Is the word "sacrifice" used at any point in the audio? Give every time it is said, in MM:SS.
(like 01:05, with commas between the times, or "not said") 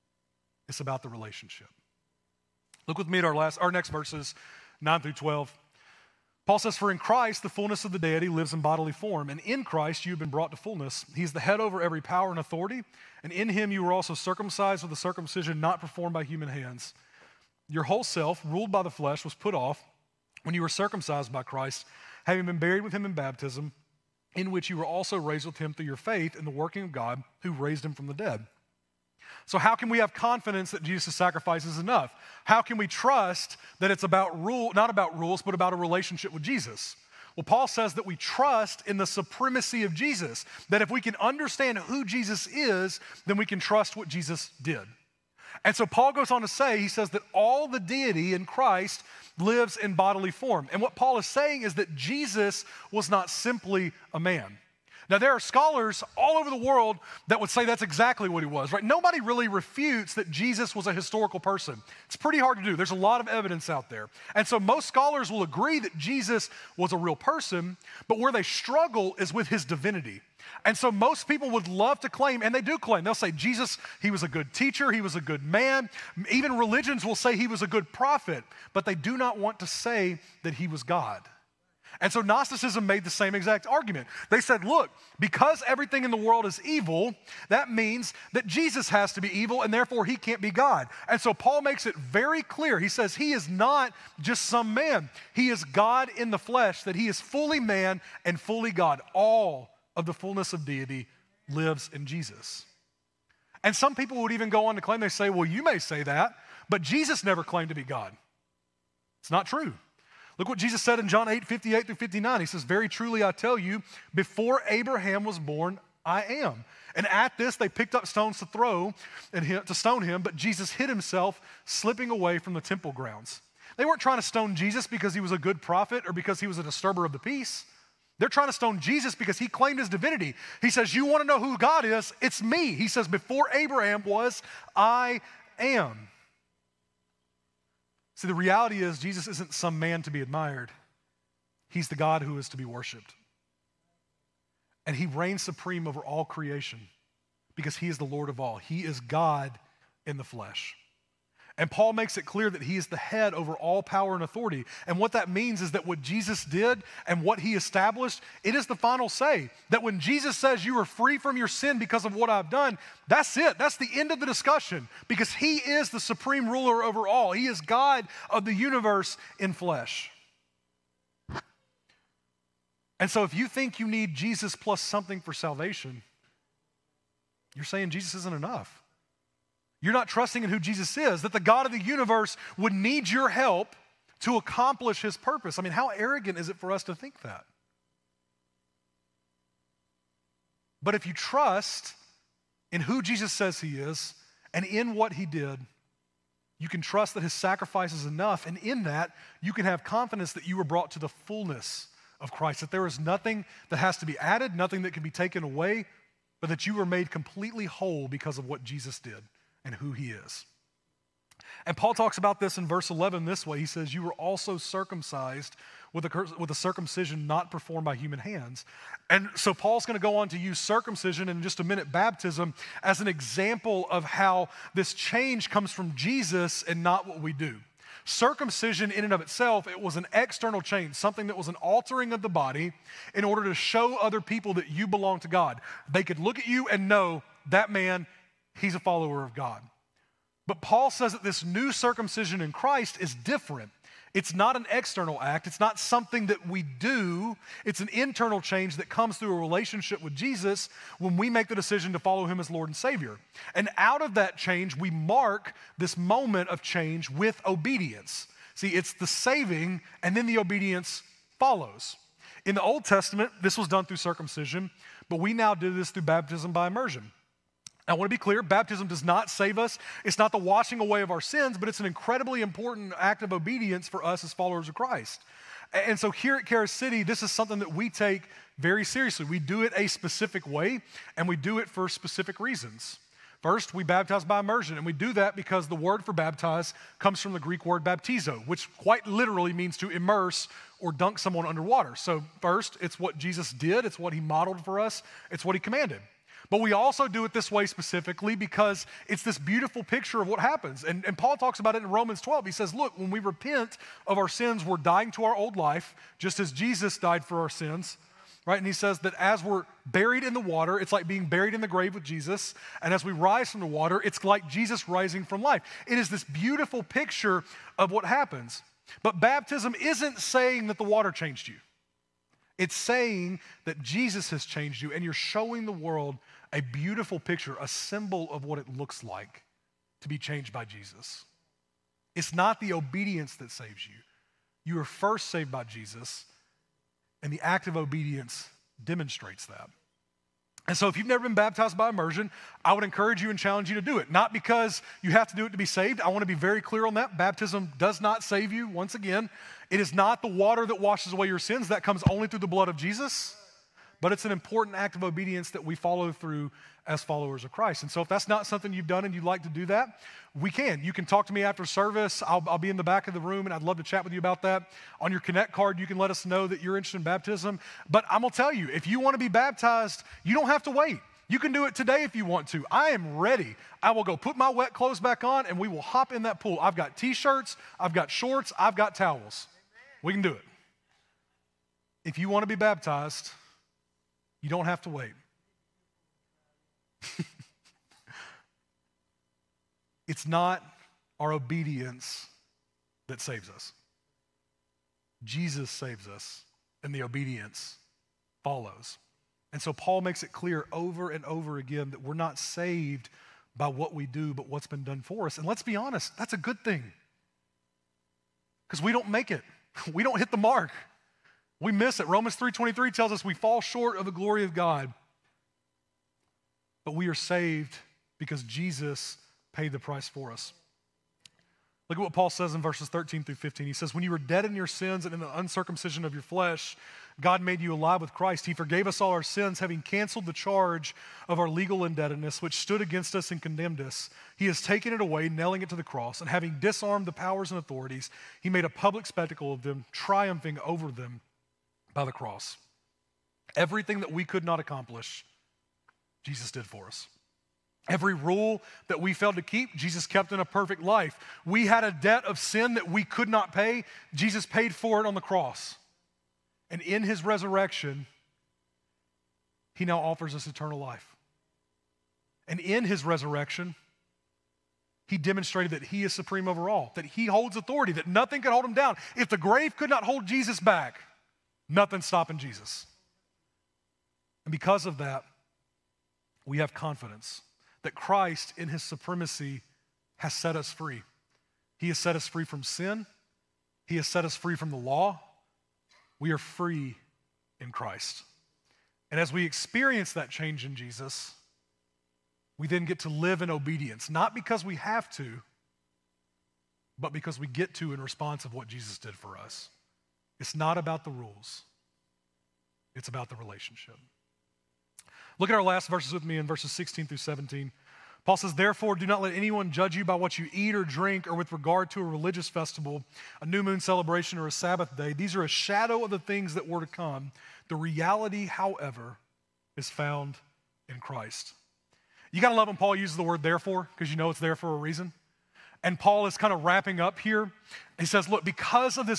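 00:31, 03:17.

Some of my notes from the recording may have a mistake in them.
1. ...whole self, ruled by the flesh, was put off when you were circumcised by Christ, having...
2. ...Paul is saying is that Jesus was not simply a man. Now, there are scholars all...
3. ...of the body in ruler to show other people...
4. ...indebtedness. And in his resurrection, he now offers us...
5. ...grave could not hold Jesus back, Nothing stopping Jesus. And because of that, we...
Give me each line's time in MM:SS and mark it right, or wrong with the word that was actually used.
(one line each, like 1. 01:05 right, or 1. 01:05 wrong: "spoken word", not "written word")
1. 00:17 right
2. 00:50 right
3. 03:52 wrong: "order", not "ruler"
4. 07:35 wrong: "cross", not "indebtedness"
5. 07:49 right.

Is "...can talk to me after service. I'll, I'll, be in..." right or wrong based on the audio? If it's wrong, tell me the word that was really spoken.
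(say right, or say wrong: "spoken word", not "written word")
right.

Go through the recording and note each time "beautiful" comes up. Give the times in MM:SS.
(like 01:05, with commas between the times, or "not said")
04:59, 05:16, 05:26.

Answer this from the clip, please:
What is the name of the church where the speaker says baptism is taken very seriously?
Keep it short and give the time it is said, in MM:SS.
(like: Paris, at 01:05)
Charis City, at 04:36.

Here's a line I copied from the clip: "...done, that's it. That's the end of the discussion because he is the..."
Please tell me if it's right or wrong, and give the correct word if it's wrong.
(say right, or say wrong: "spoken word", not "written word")
right.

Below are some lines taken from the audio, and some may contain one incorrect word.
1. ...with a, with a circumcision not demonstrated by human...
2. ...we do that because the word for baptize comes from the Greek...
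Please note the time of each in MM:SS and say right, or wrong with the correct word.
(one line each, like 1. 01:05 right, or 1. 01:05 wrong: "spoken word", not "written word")
1. 03:35 wrong: "performed", not "demonstrated"
2. 04:44 right.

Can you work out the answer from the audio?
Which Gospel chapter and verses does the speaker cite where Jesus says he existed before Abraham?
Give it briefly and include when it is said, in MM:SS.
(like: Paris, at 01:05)
John 8:58-59, at 01:51.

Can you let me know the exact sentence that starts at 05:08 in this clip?
And he says that as we're buried in the water, it's like being buried in the grave with Jesus.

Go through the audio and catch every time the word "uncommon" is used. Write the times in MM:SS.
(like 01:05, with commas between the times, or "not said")
not said.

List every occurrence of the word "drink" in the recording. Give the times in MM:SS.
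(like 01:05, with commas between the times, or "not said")
08:30.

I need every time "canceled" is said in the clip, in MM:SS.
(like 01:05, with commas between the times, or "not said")
07:09.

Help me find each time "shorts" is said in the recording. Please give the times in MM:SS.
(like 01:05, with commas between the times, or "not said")
06:18, 06:53.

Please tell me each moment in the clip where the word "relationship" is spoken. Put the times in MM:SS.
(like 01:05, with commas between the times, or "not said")
00:01, 00:35, 04:09, 08:23.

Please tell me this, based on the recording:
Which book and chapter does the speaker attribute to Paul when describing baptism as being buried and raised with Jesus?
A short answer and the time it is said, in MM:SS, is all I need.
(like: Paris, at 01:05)
Romans 12, at 05:01.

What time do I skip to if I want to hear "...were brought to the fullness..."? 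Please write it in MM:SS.
03:20.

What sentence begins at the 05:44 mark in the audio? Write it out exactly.
Not because you have to do it to be saved.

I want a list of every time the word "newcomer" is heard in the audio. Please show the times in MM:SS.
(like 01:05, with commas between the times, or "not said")
not said.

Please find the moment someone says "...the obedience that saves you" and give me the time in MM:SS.
05:32.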